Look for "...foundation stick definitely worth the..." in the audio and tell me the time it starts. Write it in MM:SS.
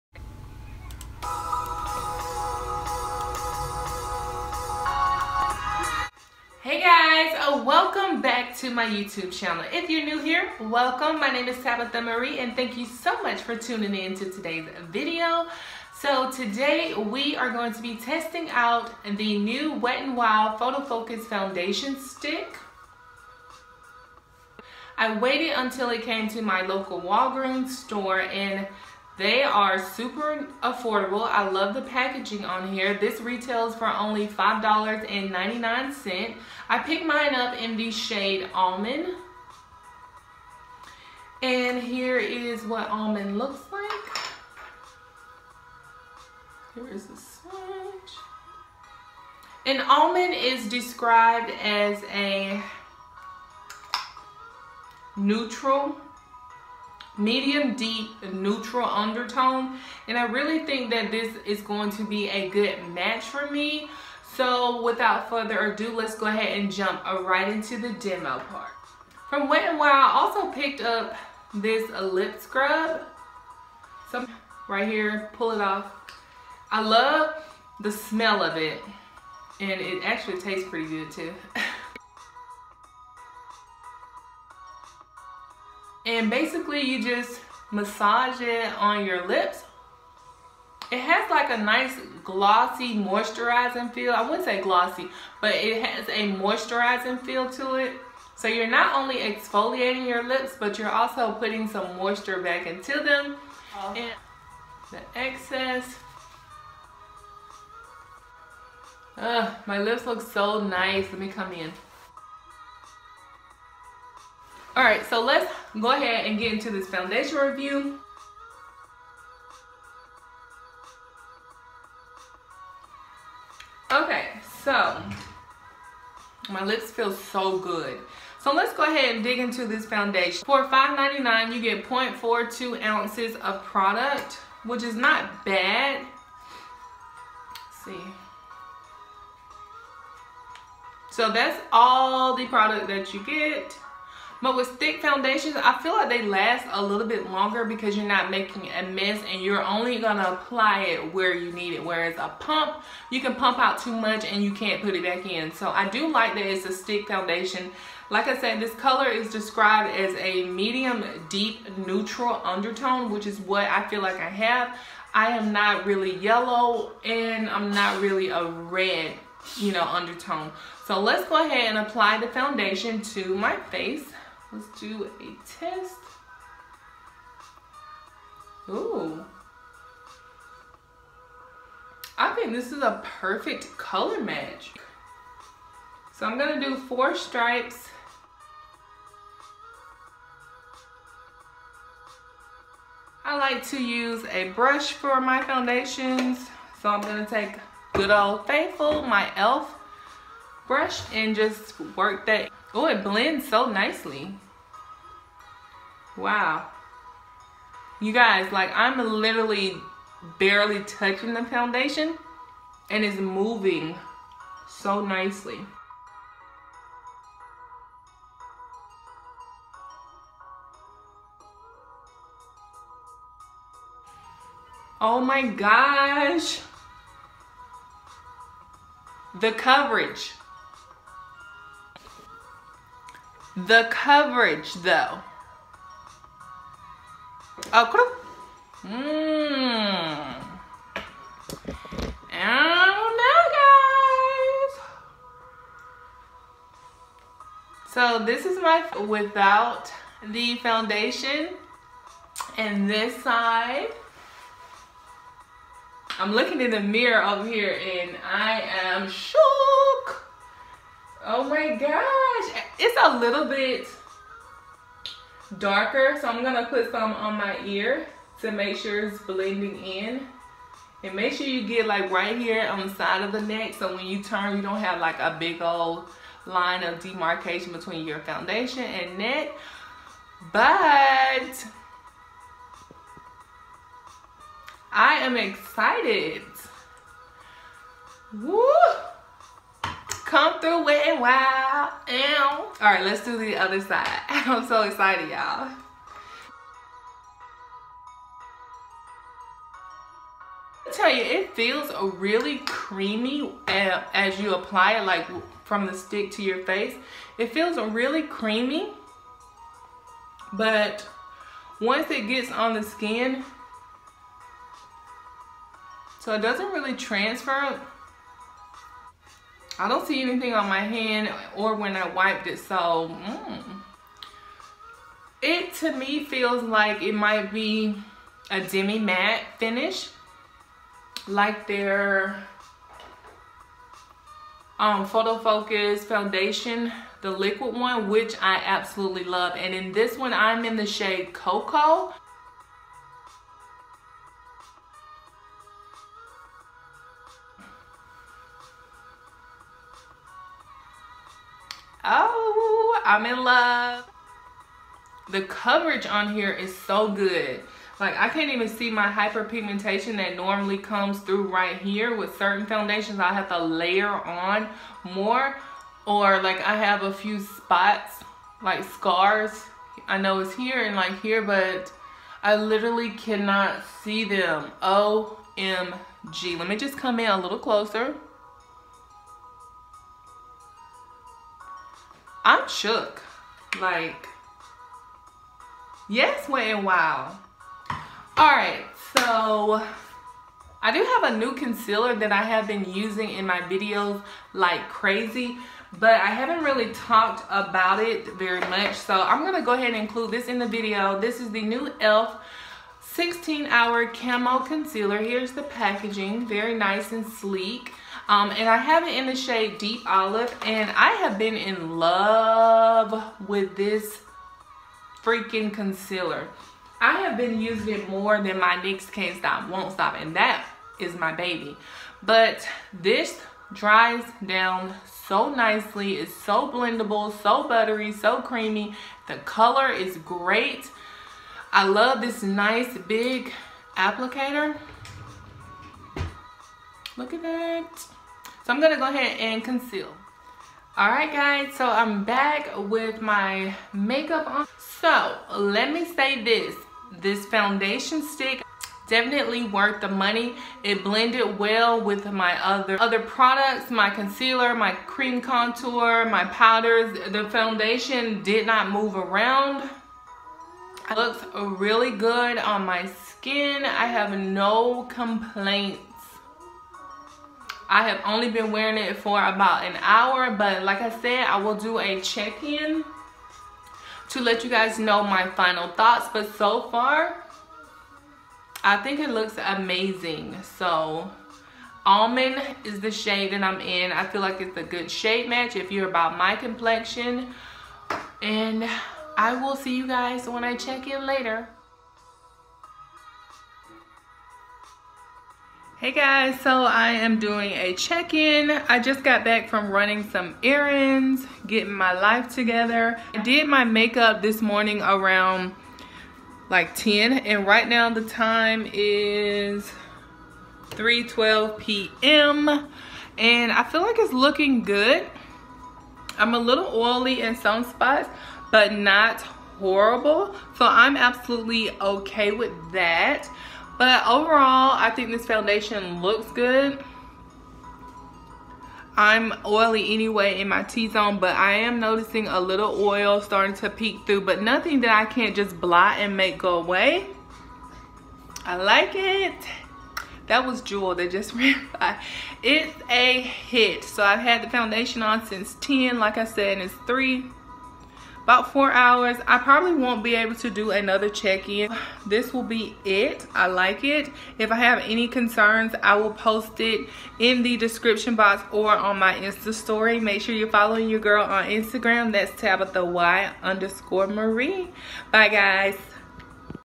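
07:27.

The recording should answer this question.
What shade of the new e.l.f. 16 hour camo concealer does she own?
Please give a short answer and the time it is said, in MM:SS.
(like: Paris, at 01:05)
Deep Olive, at 06:49.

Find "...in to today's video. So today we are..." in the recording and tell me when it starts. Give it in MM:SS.
00:13.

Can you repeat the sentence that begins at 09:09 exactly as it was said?
I probably won't be able to do another check-in.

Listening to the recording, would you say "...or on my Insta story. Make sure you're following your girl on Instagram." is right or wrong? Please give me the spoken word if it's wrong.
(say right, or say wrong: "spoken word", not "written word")
right.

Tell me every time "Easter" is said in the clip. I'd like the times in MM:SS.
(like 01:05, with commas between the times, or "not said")
not said.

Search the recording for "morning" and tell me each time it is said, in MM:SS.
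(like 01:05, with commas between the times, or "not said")
08:24.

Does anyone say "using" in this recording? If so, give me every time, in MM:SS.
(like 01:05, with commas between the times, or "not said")
06:32, 06:57.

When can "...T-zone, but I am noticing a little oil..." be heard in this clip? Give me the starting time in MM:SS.
08:50.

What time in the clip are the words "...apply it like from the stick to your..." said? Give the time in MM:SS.
05:04.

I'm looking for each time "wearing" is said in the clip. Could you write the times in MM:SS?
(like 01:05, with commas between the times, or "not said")
07:48.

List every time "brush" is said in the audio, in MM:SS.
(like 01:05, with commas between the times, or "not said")
03:14, 03:20.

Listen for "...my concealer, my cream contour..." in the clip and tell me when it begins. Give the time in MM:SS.
07:33.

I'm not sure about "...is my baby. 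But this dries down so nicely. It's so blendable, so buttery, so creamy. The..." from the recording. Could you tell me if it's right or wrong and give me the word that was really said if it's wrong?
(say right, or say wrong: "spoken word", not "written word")
right.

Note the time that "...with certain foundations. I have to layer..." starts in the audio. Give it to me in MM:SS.
06:02.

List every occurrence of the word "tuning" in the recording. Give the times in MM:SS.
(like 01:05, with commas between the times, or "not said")
00:13.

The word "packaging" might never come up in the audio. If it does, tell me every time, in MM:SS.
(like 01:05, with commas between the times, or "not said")
00:31, 06:45.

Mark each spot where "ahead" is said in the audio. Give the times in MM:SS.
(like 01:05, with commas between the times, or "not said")
01:06, 01:55, 02:08, 02:51, 06:39, 07:19.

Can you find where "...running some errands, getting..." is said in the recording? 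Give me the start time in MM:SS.
08:19.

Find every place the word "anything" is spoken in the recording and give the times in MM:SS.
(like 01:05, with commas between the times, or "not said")
05:20.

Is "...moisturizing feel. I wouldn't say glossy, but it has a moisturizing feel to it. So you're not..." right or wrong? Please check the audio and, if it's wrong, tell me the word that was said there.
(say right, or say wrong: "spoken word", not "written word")
right.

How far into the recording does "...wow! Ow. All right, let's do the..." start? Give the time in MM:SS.
04:51.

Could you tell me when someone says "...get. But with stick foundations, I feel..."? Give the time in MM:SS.
02:23.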